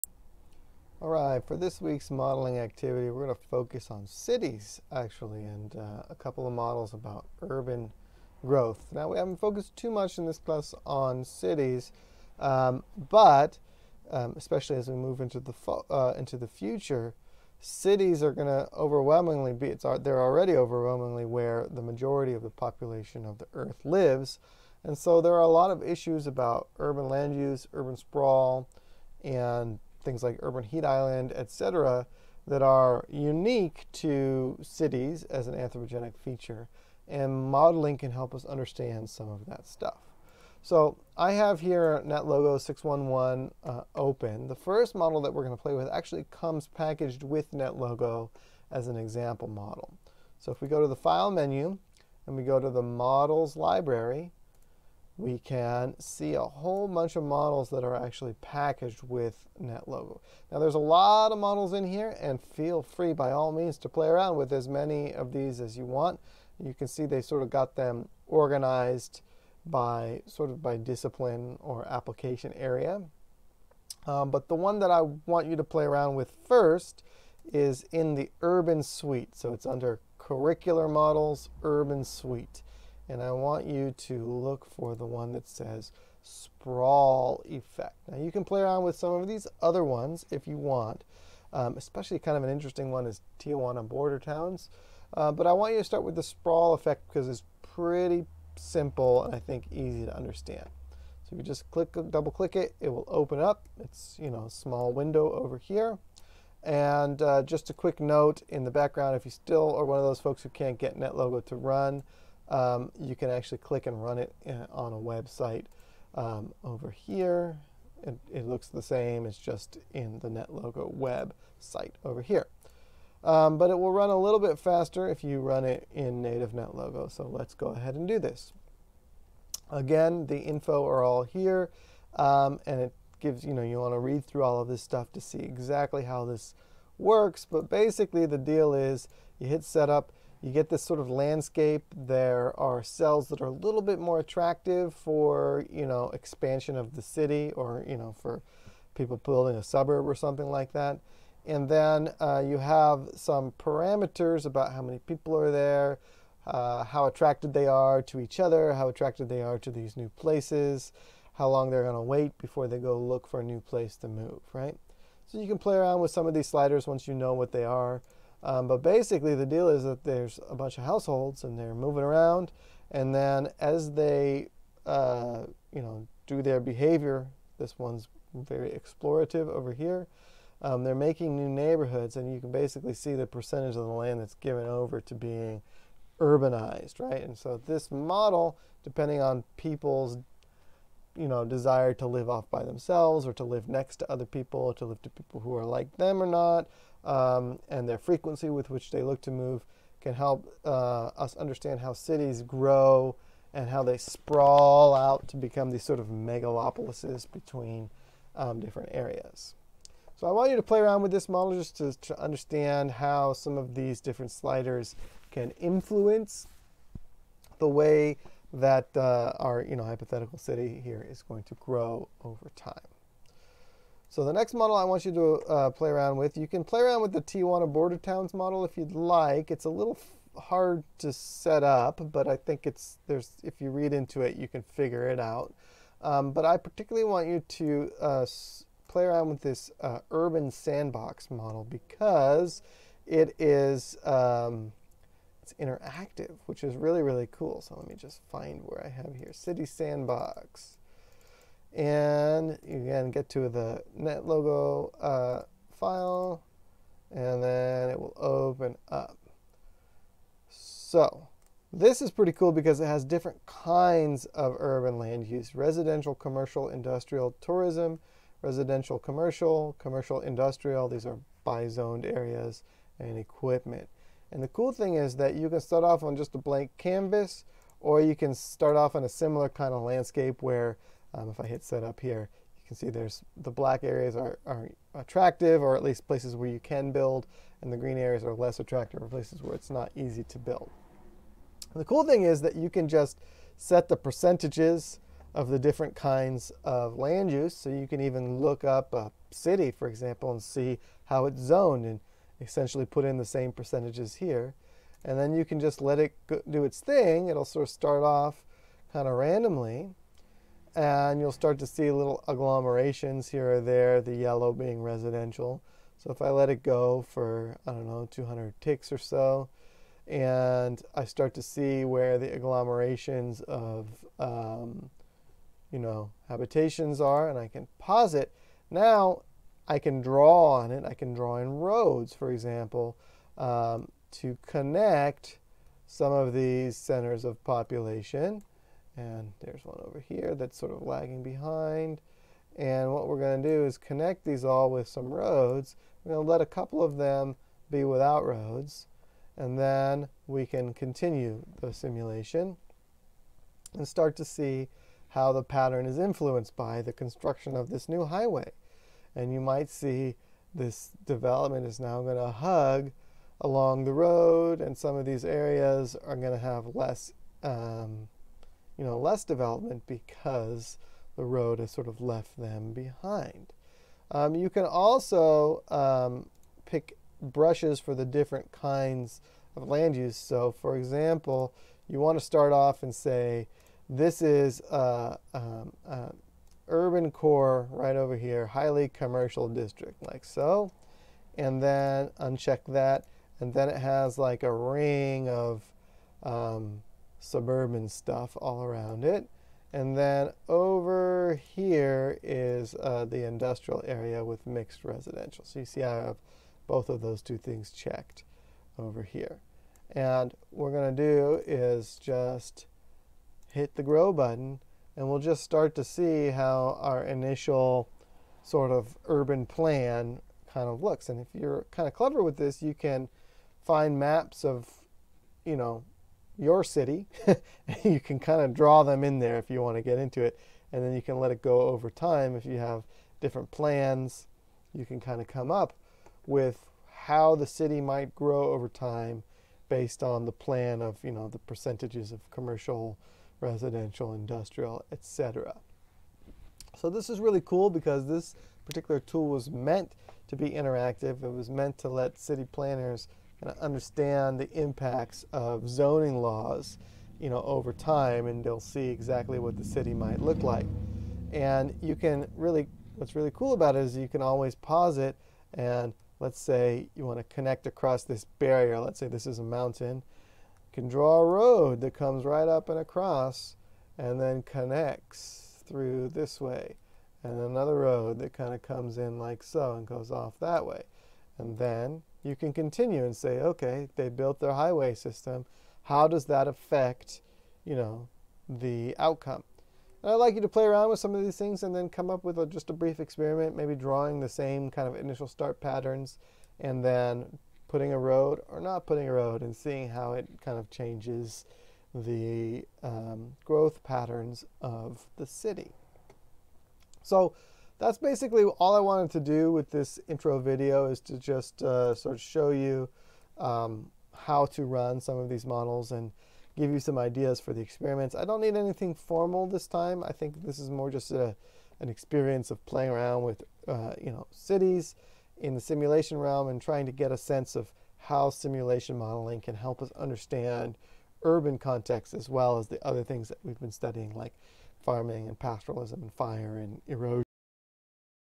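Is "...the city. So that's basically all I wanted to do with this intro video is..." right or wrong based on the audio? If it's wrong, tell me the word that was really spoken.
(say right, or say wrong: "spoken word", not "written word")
right.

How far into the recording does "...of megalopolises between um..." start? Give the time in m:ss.
3:25.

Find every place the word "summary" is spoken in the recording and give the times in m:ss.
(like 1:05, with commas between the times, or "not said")
not said.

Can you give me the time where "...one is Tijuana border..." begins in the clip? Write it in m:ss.
1:32.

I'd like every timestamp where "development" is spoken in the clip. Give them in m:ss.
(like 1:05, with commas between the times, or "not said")
6:01, 6:09.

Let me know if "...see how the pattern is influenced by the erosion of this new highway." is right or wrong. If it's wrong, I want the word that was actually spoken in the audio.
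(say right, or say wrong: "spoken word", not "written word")
wrong: "construction", not "erosion".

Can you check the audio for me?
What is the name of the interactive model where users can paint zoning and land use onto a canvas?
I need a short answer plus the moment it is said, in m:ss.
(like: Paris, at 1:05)
City Sandbox, at 4:09.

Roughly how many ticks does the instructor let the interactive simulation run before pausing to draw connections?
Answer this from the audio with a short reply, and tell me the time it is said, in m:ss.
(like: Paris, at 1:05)
200, at 5:18.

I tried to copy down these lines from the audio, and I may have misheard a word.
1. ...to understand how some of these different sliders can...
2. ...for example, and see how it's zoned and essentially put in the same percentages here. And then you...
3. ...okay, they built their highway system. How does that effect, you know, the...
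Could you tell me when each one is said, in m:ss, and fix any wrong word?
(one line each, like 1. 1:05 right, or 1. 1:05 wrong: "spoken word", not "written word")
1. 3:32 right
2. 4:59 right
3. 8:03 wrong: "affect", not "effect".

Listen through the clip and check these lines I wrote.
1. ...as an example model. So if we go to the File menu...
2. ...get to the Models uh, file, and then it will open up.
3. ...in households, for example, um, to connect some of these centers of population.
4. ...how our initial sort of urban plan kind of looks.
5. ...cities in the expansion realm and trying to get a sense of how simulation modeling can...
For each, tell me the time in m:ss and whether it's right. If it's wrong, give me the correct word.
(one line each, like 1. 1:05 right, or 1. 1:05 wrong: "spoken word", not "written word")
1. 0:48 right
2. 4:13 wrong: "NetLogo", not "Models"
3. 5:31 wrong: "roads", not "households"
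4. 6:56 right
5. 8:44 wrong: "simulation", not "expansion".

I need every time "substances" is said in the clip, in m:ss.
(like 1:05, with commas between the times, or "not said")
not said.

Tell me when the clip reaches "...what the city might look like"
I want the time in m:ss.
7:39.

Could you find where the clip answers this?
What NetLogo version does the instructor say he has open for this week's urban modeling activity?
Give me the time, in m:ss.
0:42.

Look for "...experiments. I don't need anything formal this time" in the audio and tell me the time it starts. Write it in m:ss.
8:37.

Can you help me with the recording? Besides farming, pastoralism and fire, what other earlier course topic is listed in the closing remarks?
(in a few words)
erosion.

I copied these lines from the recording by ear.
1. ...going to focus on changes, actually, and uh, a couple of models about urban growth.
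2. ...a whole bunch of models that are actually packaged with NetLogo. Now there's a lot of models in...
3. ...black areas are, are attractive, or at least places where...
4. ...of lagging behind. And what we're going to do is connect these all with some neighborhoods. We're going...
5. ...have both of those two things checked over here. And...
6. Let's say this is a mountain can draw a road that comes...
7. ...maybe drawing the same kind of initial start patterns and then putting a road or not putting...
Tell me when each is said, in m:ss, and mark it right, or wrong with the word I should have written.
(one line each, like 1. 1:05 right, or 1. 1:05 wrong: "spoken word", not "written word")
1. 0:03 wrong: "cities", not "changes"
2. 0:56 right
3. 4:43 right
4. 5:40 wrong: "roads", not "neighborhoods"
5. 6:46 right
6. 7:48 right
7. 8:13 right.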